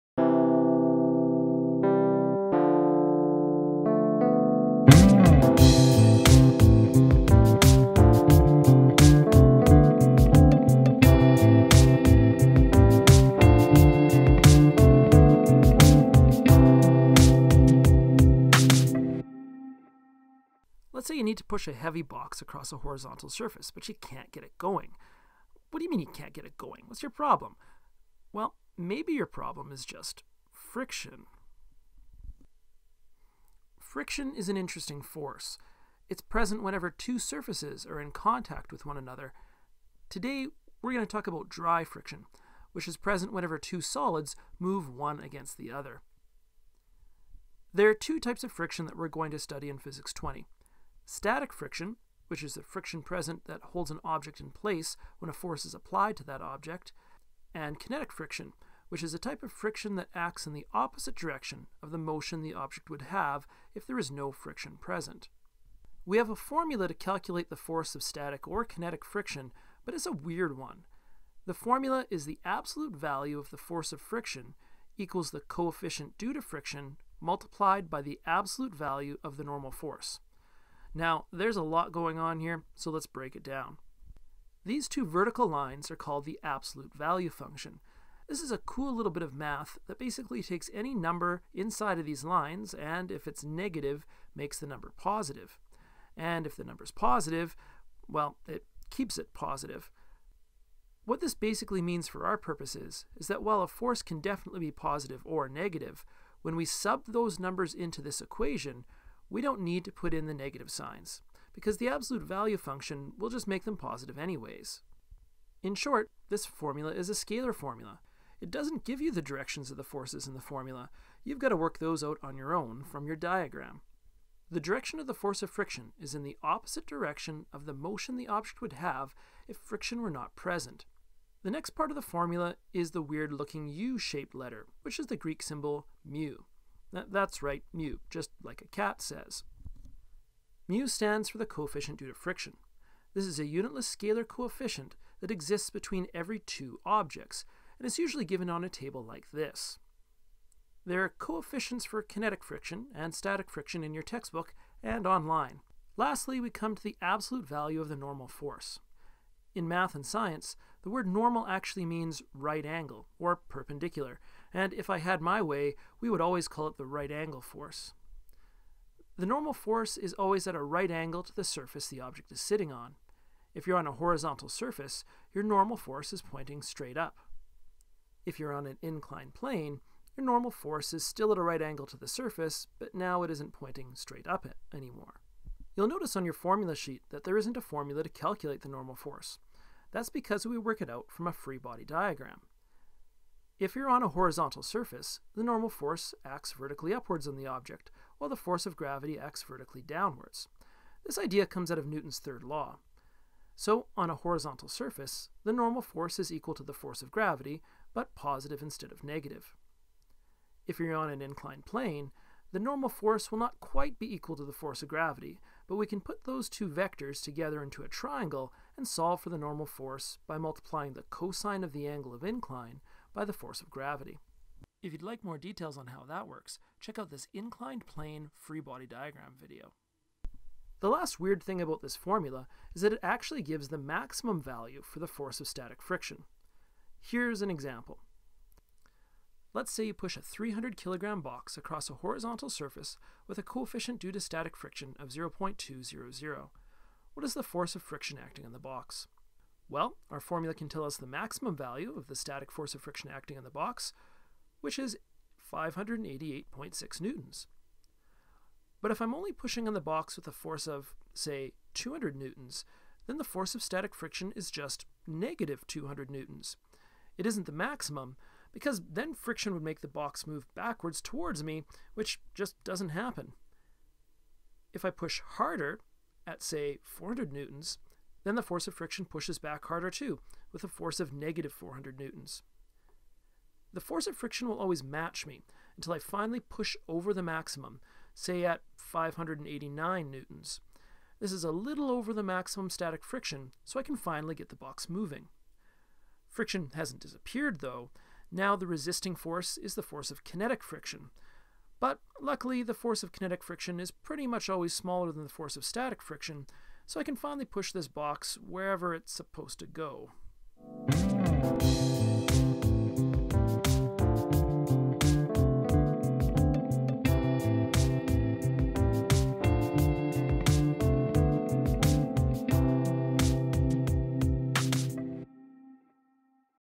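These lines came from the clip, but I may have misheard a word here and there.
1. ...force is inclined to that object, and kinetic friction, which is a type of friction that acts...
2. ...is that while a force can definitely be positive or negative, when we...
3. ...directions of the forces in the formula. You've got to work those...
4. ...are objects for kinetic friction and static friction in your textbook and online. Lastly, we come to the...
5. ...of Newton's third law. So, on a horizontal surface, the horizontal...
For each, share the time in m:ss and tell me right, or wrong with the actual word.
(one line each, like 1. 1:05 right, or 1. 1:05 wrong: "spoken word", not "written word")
1. 0:55 wrong: "applied", not "inclined"
2. 1:43 right
3. 1:59 right
4. 2:31 wrong: "coefficients", not "objects"
5. 3:21 wrong: "normal", not "horizontal".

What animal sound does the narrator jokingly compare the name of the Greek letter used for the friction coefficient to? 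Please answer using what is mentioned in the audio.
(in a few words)
a cat.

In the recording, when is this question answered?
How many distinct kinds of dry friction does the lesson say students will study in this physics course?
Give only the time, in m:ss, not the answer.
0:47.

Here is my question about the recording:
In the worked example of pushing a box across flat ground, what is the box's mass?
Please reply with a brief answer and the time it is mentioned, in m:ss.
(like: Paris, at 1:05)
300 kilograms, at 4:00.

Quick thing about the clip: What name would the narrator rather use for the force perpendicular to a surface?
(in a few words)
the right angle force.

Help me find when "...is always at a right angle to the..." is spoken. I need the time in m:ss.
2:49.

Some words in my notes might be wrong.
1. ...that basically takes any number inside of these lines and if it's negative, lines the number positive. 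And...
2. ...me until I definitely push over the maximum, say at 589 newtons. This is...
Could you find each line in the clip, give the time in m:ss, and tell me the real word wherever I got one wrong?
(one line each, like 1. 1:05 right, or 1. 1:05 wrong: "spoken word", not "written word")
1. 1:29 wrong: "makes", not "lines"
2. 4:45 wrong: "finally", not "definitely".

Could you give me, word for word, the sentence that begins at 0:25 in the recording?
What do you mean you can't get it going?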